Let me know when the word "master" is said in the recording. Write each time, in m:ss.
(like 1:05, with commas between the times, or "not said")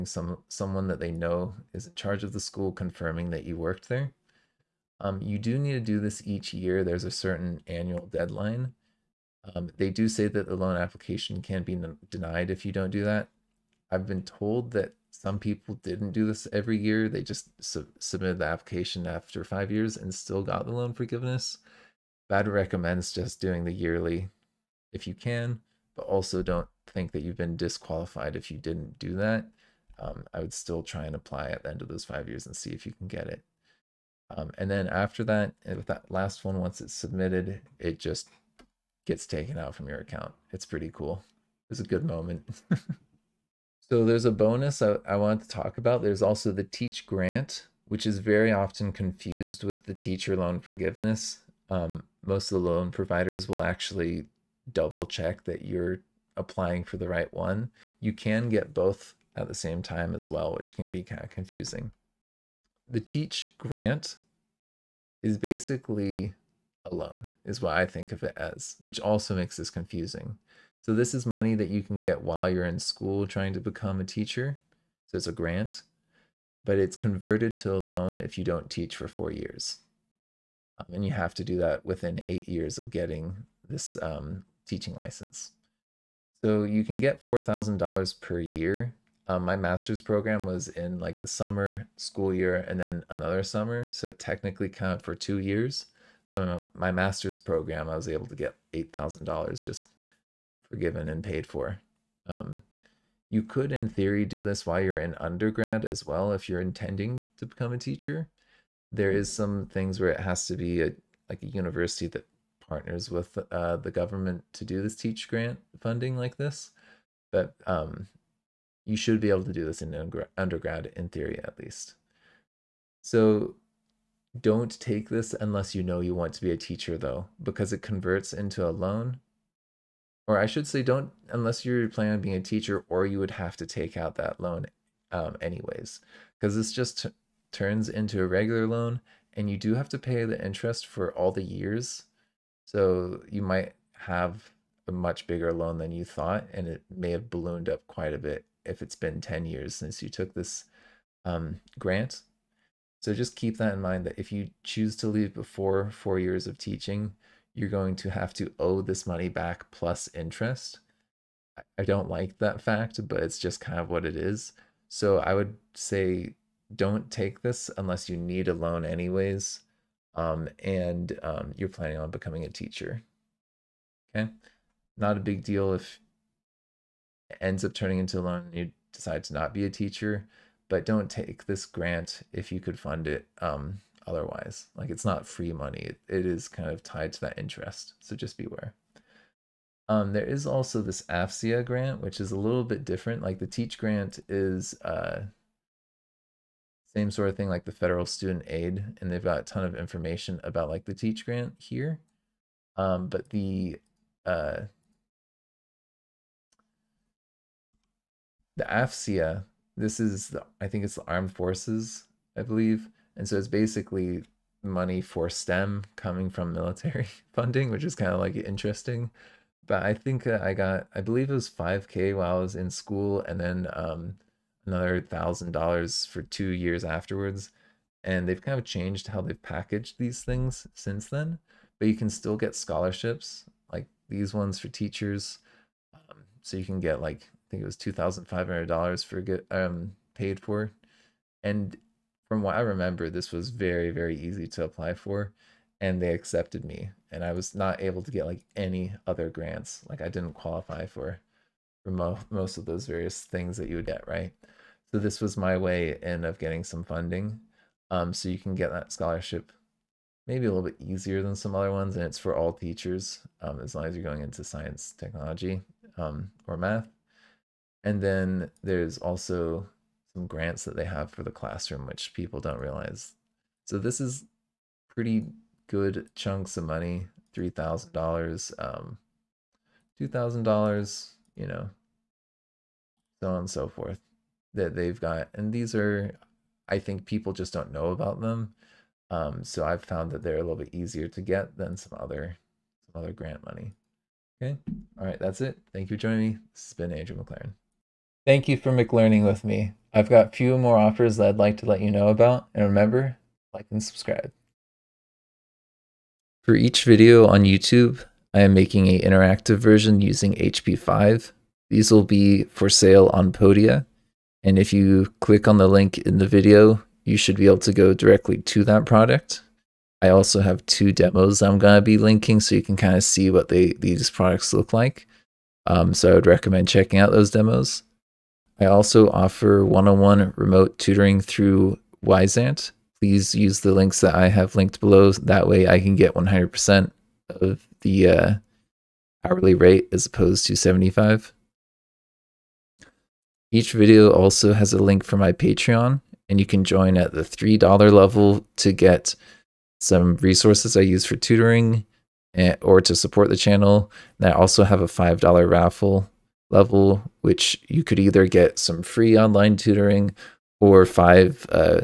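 1:29, 1:36.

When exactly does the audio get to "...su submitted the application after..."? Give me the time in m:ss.
0:17.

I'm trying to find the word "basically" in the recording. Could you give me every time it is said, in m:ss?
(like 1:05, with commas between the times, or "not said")
1:05, 3:33.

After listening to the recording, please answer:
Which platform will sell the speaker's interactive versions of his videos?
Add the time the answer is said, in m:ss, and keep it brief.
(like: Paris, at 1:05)
Podia, at 5:13.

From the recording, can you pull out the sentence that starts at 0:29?
Um, I would still try and apply at the end of those five years and see if you can get it.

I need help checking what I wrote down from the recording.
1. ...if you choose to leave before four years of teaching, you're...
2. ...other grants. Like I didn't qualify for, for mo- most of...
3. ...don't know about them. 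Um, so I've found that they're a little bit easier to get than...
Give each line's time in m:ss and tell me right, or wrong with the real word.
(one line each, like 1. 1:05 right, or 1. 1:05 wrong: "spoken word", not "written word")
1. 2:34 right
2. 4:09 right
3. 4:47 right.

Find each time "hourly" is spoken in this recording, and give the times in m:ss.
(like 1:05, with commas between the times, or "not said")
5:39.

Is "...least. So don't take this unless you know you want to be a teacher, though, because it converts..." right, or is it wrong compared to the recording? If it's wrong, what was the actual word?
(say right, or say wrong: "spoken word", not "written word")
right.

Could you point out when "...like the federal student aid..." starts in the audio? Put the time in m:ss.
3:17.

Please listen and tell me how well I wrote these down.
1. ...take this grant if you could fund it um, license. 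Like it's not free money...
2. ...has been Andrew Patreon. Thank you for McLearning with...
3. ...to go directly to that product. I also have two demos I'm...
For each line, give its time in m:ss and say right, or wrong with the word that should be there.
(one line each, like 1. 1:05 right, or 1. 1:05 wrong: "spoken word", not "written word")
1. 3:01 wrong: "otherwise", not "license"
2. 4:56 wrong: "McLaren", not "Patreon"
3. 5:17 right.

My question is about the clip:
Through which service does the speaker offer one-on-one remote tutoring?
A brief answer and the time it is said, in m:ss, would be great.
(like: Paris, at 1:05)
Wyzant, at 5:32.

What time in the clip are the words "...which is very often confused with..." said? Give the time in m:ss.
0:47.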